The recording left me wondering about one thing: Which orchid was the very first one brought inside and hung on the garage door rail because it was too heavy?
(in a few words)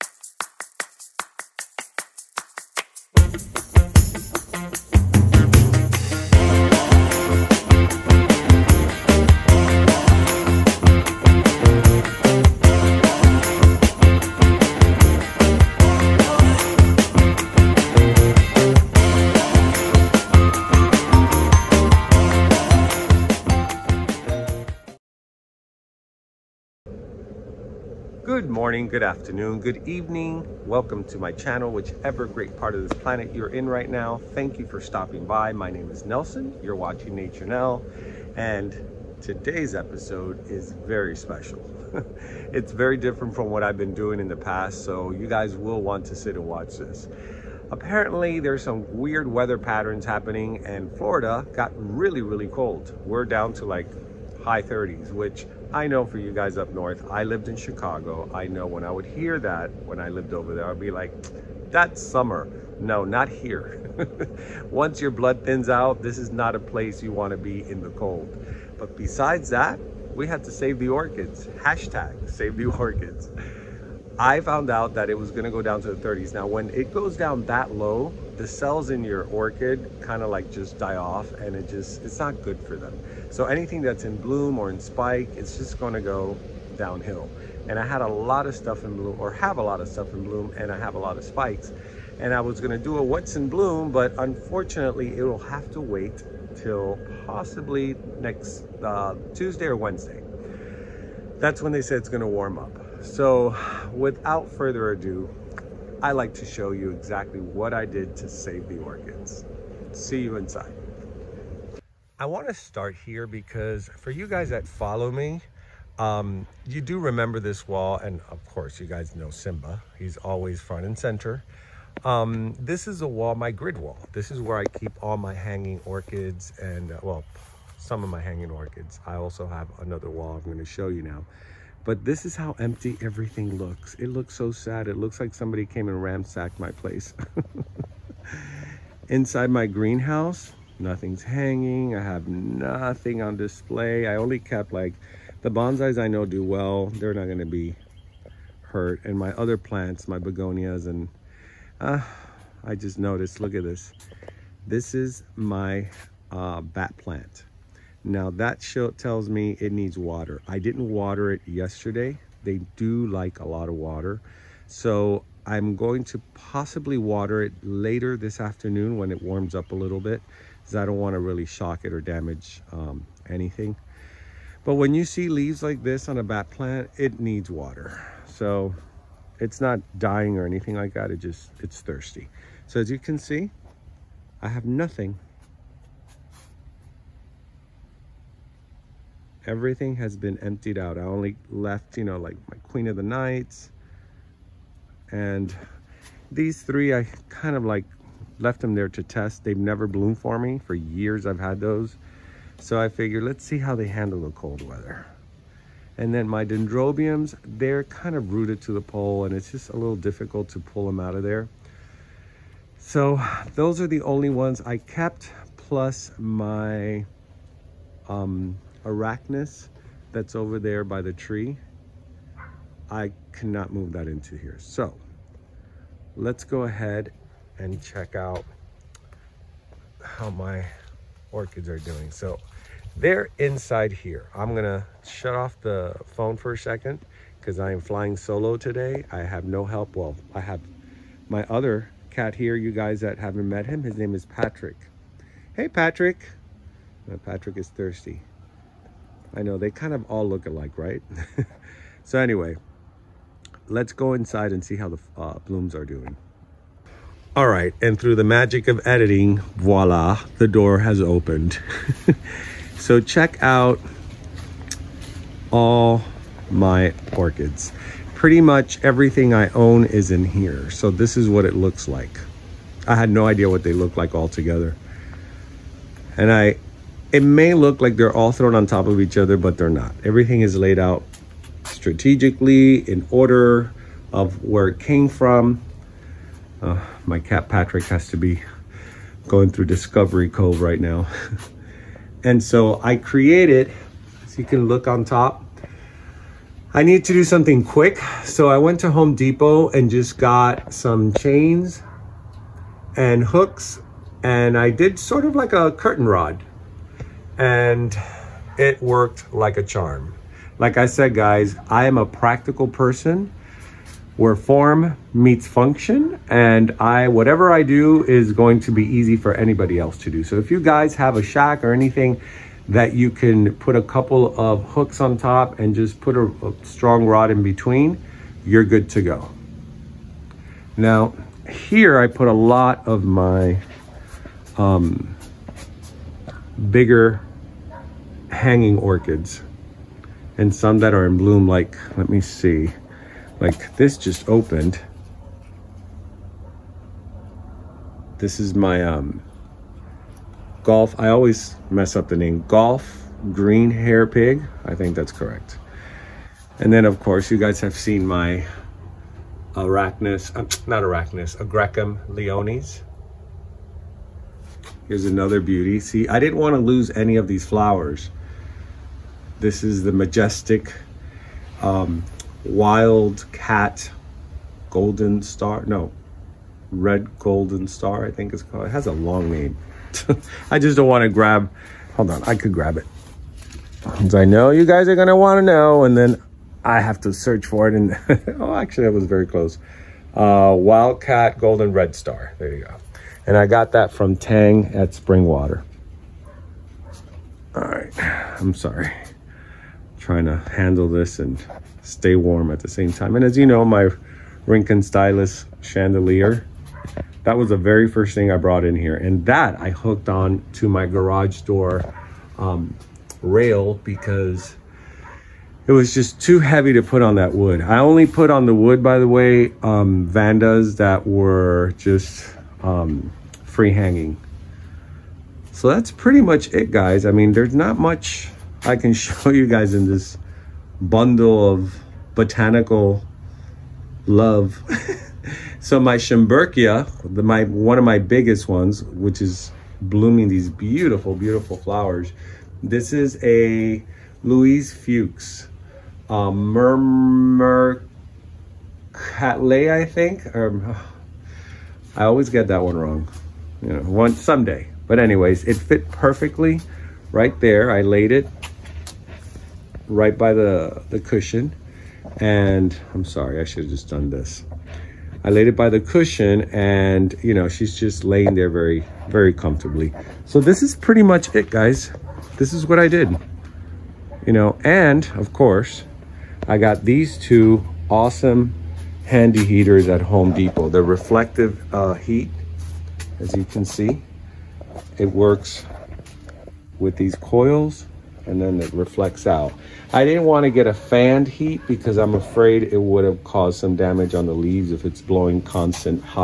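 Rhynchostylis chandelier.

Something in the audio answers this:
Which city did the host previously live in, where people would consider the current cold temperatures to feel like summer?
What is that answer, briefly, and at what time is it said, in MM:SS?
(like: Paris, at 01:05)
Chicago, at 00:57.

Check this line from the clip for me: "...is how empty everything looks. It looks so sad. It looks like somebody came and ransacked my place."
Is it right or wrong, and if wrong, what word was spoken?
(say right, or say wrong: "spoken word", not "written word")
right.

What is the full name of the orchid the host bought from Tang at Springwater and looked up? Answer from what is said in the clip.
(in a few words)
Wildcat Golden Red Star.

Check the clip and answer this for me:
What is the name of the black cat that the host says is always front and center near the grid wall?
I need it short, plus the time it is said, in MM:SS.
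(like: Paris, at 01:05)
Simba, at 01:59.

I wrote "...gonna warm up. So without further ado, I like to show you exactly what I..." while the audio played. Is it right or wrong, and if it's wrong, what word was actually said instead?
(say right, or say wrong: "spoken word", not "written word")
right.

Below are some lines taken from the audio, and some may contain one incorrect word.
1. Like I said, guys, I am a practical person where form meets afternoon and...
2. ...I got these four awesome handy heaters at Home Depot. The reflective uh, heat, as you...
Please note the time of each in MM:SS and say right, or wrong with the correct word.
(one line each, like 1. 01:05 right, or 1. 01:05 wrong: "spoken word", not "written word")
1. 05:10 wrong: "function", not "afternoon"
2. 07:56 wrong: "two", not "four".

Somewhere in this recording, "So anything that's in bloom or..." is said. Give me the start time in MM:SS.
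01:23.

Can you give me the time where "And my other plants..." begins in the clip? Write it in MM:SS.
02:29.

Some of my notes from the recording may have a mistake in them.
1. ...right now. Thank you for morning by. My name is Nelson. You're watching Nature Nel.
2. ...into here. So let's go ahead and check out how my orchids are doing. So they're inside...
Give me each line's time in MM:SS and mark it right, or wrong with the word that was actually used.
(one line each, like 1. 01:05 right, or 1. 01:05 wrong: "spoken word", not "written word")
1. 00:33 wrong: "stopping", not "morning"
2. 03:44 right.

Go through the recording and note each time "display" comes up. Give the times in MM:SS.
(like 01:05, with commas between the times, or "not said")
02:23.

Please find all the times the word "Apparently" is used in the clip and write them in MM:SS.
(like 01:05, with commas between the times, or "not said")
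00:47.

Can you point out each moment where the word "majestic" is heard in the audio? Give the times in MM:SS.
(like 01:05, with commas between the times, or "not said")
06:09.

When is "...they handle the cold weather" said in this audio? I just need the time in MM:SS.
03:23.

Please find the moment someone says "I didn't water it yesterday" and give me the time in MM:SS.
02:40.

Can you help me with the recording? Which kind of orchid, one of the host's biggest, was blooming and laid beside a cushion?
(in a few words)
Schomburgkia.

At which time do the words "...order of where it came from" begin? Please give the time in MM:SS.
04:43.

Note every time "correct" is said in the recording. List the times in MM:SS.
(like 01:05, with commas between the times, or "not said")
05:55.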